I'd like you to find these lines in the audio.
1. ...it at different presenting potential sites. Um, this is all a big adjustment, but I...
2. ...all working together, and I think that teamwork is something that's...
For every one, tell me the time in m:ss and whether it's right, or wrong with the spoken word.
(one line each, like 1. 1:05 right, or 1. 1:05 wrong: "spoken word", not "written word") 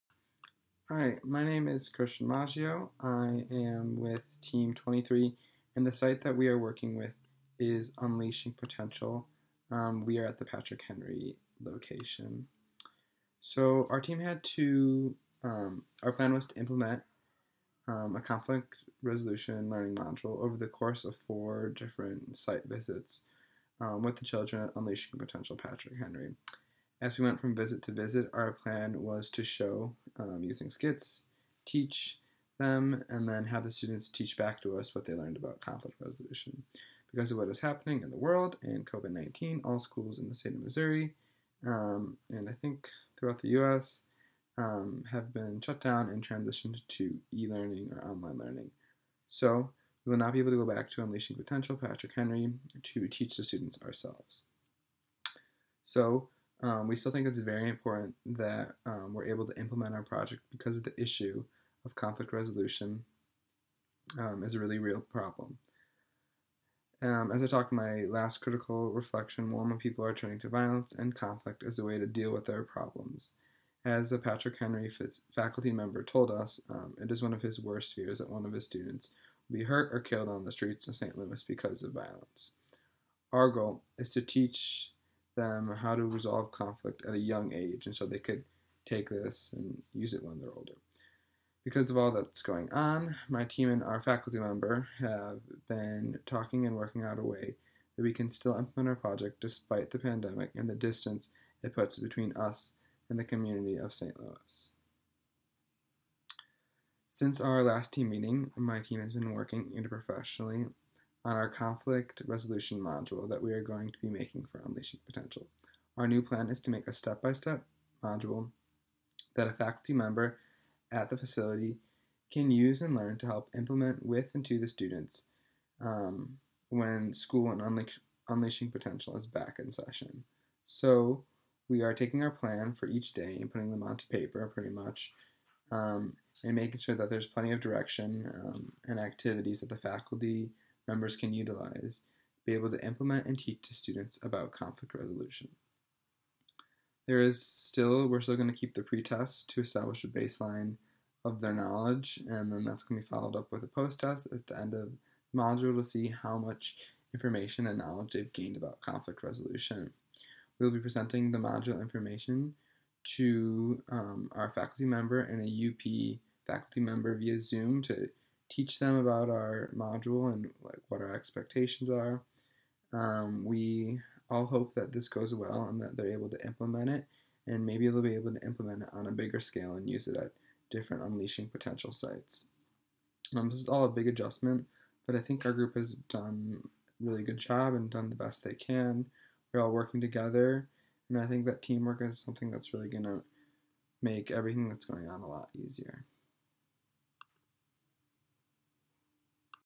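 1. 3:00 wrong: "unleashing", not "presenting"
2. 3:09 right.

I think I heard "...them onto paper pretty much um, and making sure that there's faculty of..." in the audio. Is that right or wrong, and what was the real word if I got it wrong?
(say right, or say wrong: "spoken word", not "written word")
wrong: "plenty", not "faculty".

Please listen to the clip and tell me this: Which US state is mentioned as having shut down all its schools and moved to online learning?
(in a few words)
Missouri.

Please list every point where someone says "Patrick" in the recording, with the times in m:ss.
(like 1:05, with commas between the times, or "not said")
0:10, 0:25, 0:51, 1:14.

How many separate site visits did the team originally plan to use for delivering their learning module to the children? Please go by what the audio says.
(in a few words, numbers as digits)
4.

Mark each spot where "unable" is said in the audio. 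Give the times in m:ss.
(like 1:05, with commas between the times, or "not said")
not said.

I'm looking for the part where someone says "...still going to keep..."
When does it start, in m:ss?
2:28.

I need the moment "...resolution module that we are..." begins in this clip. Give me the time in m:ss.
1:52.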